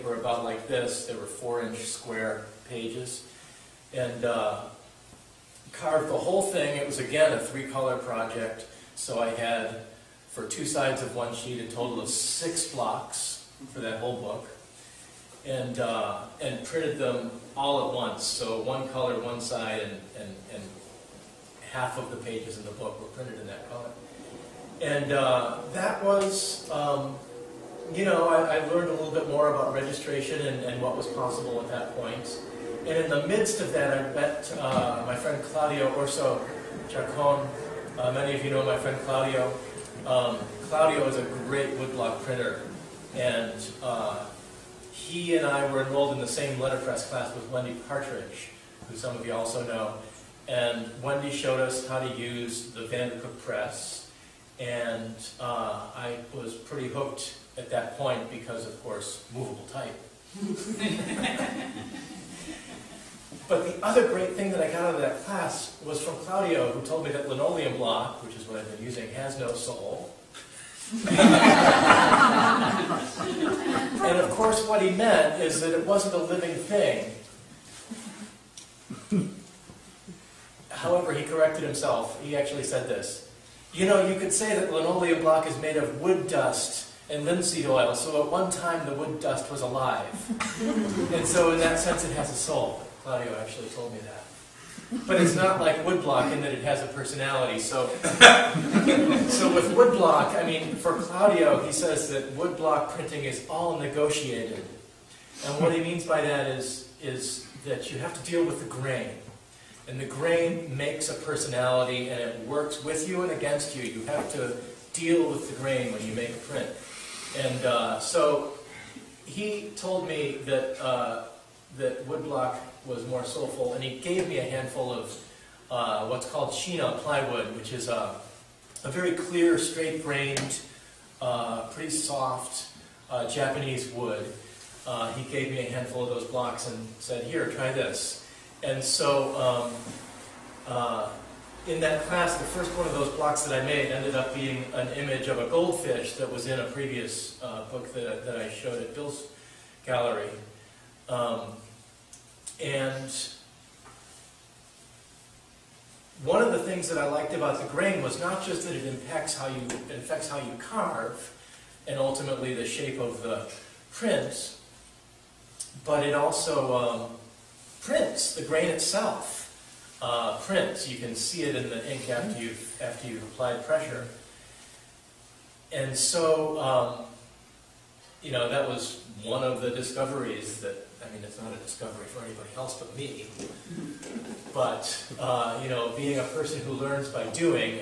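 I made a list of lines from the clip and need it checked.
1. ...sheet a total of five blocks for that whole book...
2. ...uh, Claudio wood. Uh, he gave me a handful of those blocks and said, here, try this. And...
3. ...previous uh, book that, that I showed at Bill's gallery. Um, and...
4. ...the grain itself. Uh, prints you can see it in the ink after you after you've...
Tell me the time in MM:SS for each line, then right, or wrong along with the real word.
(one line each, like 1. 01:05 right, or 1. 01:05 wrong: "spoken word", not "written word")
1. 00:11 wrong: "six", not "five"
2. 02:13 wrong: "Japanese", not "Claudio"
3. 02:26 right
4. 02:48 right.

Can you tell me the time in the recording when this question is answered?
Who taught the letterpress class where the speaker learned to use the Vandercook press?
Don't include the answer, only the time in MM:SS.
00:47.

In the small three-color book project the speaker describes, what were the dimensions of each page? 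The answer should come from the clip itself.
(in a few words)
4 inch square.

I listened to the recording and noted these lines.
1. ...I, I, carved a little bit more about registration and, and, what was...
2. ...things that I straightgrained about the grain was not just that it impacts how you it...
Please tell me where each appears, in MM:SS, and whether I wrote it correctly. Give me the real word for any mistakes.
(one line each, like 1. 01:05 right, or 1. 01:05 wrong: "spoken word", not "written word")
1. 00:28 wrong: "learned", not "carved"
2. 02:36 wrong: "liked", not "straightgrained".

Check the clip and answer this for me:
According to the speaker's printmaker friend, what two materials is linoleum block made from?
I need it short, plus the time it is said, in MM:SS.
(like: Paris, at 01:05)
Wood dust and linseed oil, at 01:26.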